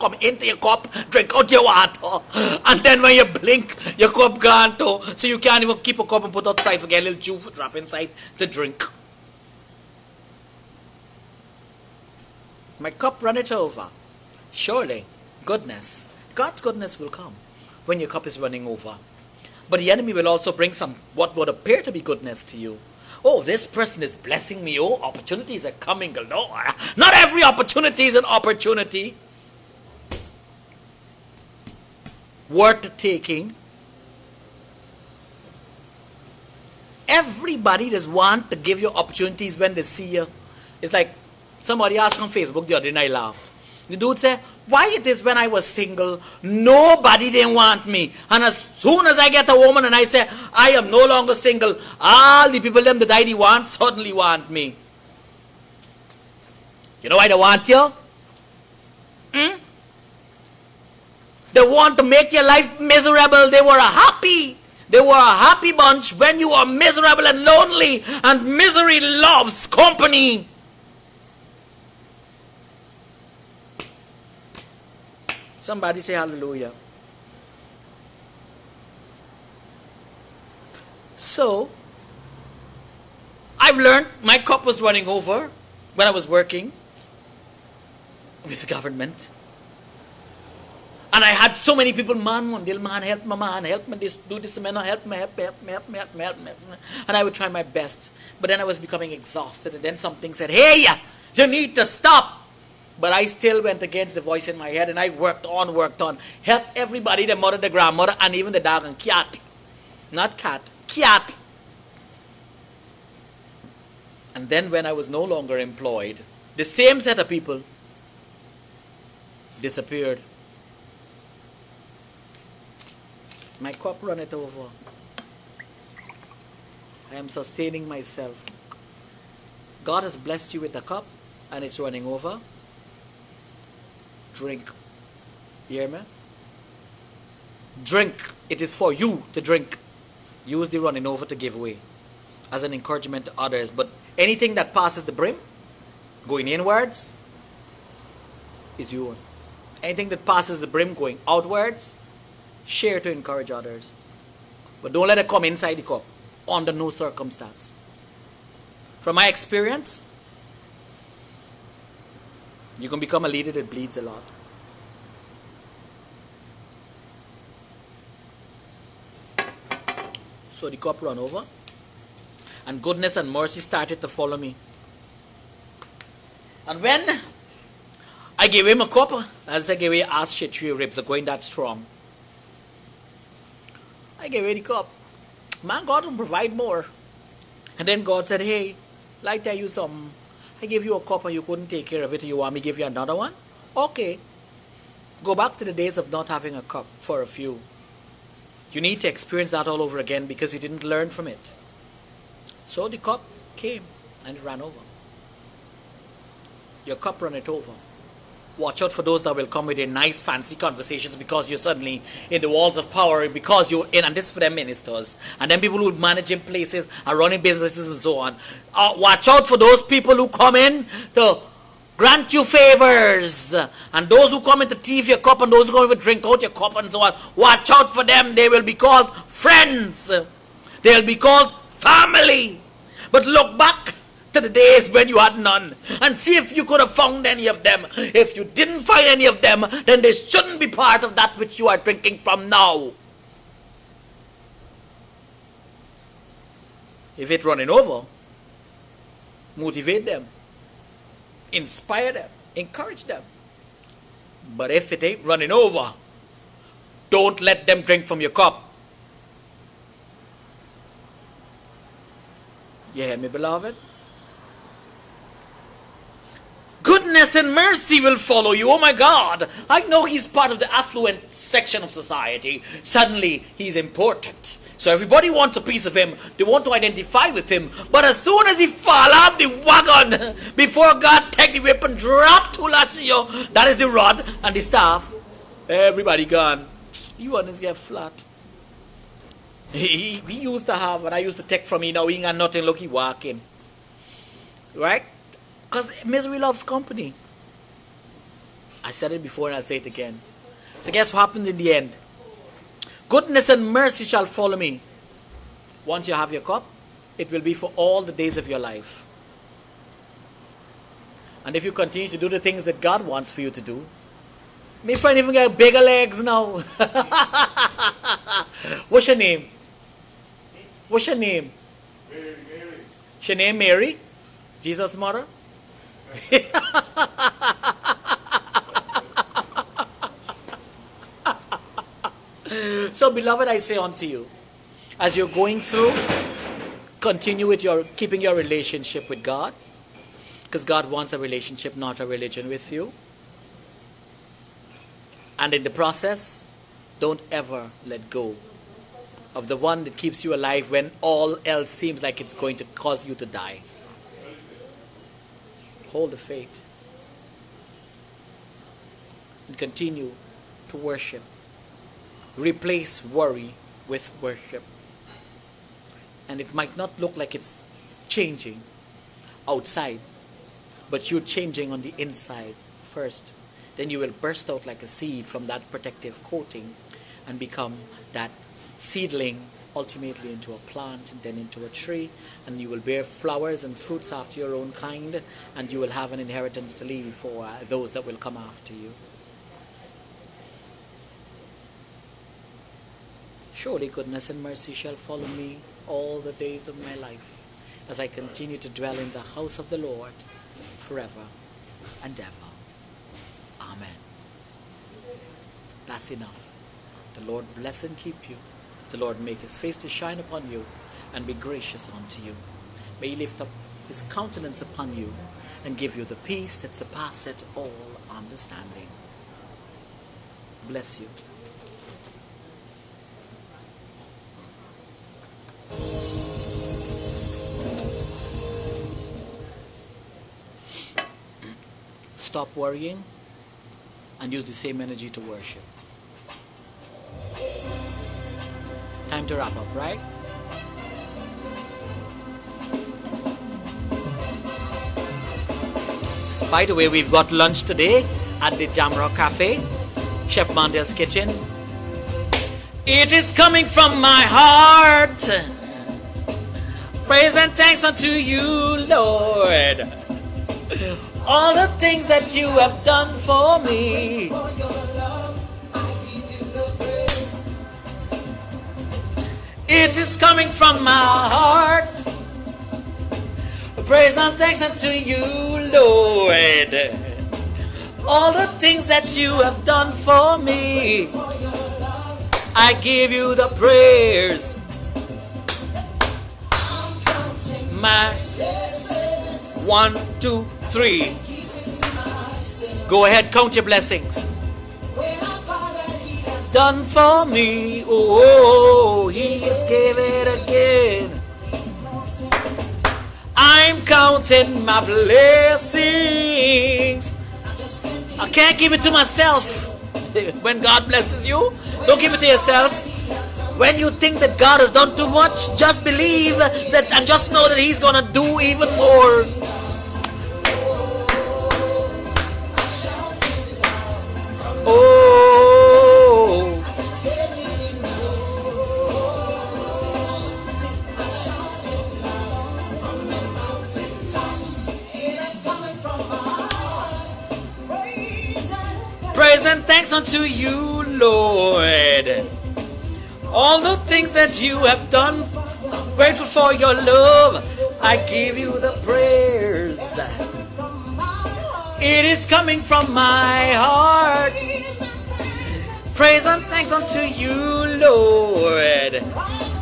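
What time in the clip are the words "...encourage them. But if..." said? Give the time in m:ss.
4:12.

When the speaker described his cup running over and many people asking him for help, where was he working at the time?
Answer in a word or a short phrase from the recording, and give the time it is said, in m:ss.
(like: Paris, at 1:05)
government, at 1:26.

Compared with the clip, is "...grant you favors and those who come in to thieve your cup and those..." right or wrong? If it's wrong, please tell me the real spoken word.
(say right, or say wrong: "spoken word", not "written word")
right.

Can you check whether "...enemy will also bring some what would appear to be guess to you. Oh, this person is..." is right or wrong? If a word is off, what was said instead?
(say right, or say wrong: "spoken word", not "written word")
wrong: "goodness", not "guess".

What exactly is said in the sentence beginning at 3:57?
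If you didn't find any of them, then they shouldn't be part of that which you are drinking from now.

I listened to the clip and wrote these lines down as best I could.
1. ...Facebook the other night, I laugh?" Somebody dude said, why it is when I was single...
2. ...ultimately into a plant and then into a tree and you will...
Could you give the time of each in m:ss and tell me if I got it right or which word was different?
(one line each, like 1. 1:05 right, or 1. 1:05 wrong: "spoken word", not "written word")
1. 0:42 wrong: "The", not "Somebody"
2. 6:19 right.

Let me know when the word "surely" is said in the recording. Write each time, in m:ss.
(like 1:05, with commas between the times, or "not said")
0:14, 6:33.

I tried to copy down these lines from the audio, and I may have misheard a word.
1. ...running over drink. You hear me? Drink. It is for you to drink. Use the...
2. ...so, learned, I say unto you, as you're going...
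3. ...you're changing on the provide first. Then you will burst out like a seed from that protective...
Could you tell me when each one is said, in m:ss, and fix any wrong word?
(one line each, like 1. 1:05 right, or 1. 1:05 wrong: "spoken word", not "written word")
1. 2:11 right
2. 5:32 wrong: "beloved", not "learned"
3. 6:11 wrong: "inside", not "provide".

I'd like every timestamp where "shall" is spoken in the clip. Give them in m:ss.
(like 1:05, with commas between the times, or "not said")
5:04, 6:34.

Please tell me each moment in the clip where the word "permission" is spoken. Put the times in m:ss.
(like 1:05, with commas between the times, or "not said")
not said.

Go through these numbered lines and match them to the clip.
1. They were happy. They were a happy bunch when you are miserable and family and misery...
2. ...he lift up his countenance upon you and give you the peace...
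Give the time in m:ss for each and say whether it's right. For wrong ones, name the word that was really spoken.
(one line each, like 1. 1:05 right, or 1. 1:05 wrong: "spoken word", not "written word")
1. 1:03 wrong: "lonely", not "family"
2. 6:53 right.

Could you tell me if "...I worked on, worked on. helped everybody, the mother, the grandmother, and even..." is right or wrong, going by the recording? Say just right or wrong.
right.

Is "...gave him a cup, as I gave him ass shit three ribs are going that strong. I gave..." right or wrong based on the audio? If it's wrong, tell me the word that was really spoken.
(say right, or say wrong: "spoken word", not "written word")
right.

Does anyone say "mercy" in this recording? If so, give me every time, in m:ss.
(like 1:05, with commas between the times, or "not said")
2:53, 4:27, 5:03, 6:34.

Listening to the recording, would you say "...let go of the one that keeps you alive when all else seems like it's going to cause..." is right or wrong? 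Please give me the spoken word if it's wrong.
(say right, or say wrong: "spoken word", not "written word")
right.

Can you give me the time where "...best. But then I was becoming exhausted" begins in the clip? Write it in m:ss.
1:37.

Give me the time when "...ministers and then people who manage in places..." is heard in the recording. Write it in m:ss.
3:34.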